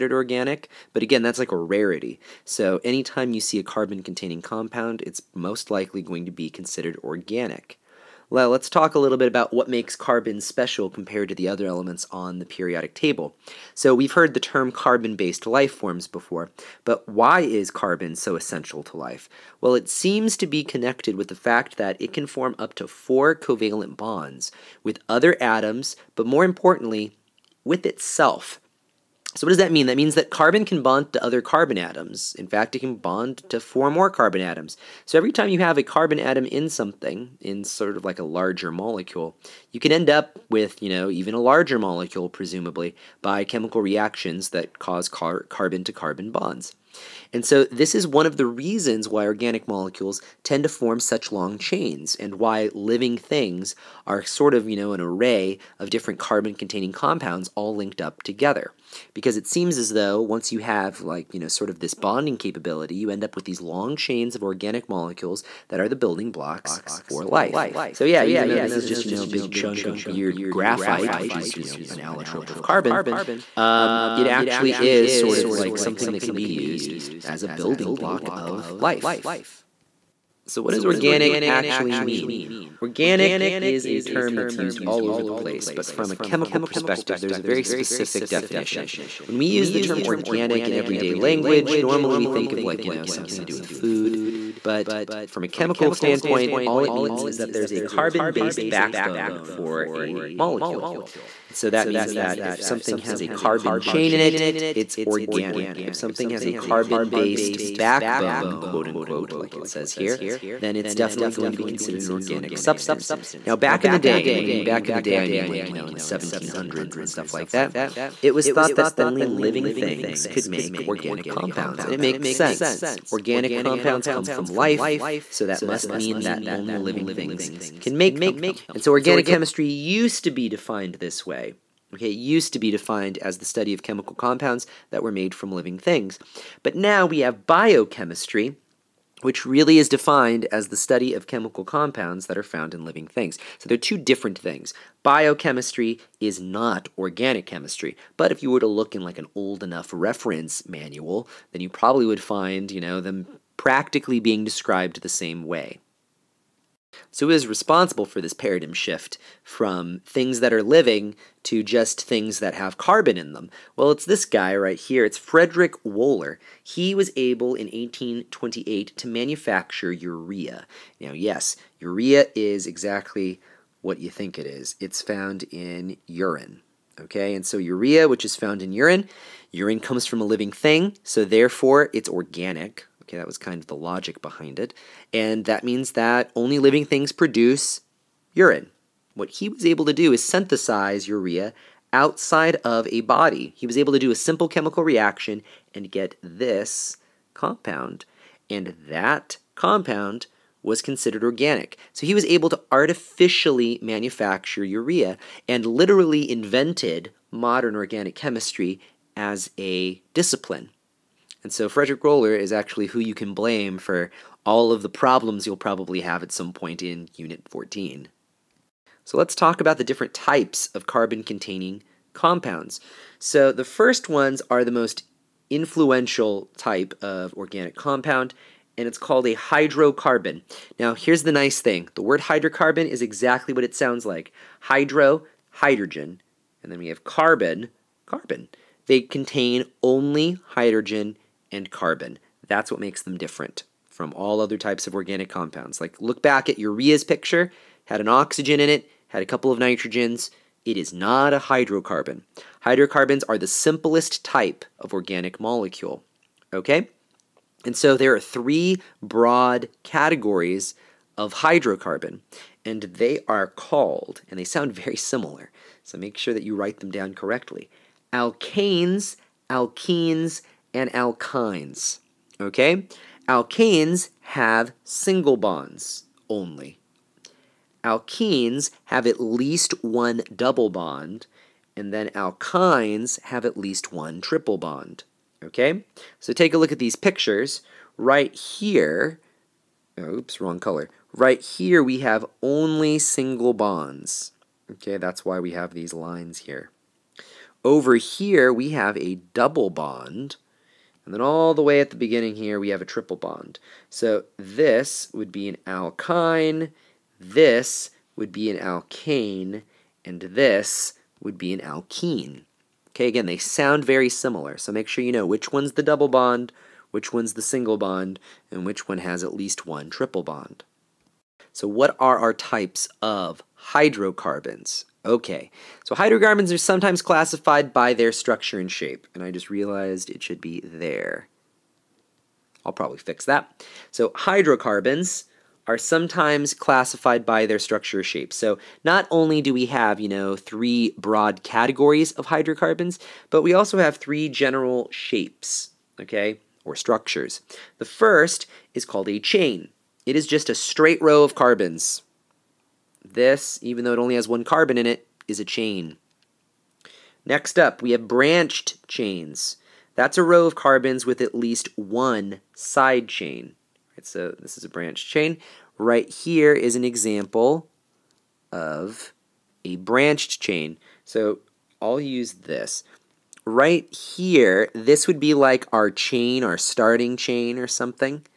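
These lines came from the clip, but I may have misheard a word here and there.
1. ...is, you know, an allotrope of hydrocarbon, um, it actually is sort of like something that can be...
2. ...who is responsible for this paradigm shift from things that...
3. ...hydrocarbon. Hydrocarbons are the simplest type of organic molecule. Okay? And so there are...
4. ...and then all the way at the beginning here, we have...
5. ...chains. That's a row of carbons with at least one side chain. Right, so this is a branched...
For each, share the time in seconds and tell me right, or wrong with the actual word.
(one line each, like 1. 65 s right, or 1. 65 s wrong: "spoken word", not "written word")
1. 71 s wrong: "carbon", not "hydrocarbon"
2. 157 s right
3. 251 s right
4. 301 s right
5. 358 s right.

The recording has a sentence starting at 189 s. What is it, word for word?
What he was able to do is synthesize urea outside of a body.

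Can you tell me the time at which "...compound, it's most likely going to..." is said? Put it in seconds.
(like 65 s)
4 s.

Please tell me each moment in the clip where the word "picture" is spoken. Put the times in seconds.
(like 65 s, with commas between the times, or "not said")
247 s, 286 s.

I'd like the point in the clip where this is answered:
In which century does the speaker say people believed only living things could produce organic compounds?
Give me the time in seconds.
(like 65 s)
115 s.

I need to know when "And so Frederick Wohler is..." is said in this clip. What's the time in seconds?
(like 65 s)
211 s.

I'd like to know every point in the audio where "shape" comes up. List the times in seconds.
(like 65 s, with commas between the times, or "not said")
328 s, 338 s, 344 s.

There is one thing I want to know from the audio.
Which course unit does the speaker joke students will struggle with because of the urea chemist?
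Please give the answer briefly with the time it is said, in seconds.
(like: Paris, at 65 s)
Unit 14, at 217 s.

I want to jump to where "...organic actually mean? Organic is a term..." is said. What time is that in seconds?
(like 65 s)
80 s.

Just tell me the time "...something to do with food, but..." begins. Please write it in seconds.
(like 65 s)
93 s.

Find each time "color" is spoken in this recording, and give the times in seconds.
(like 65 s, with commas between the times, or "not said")
290 s.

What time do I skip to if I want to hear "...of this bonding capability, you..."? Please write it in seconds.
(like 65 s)
61 s.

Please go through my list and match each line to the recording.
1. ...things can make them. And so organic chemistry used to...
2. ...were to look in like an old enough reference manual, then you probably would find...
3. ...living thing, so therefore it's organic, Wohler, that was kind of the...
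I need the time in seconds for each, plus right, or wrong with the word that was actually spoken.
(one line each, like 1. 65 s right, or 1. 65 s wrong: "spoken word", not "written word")
1. 127 s right
2. 148 s right
3. 180 s wrong: "Okay", not "Wohler".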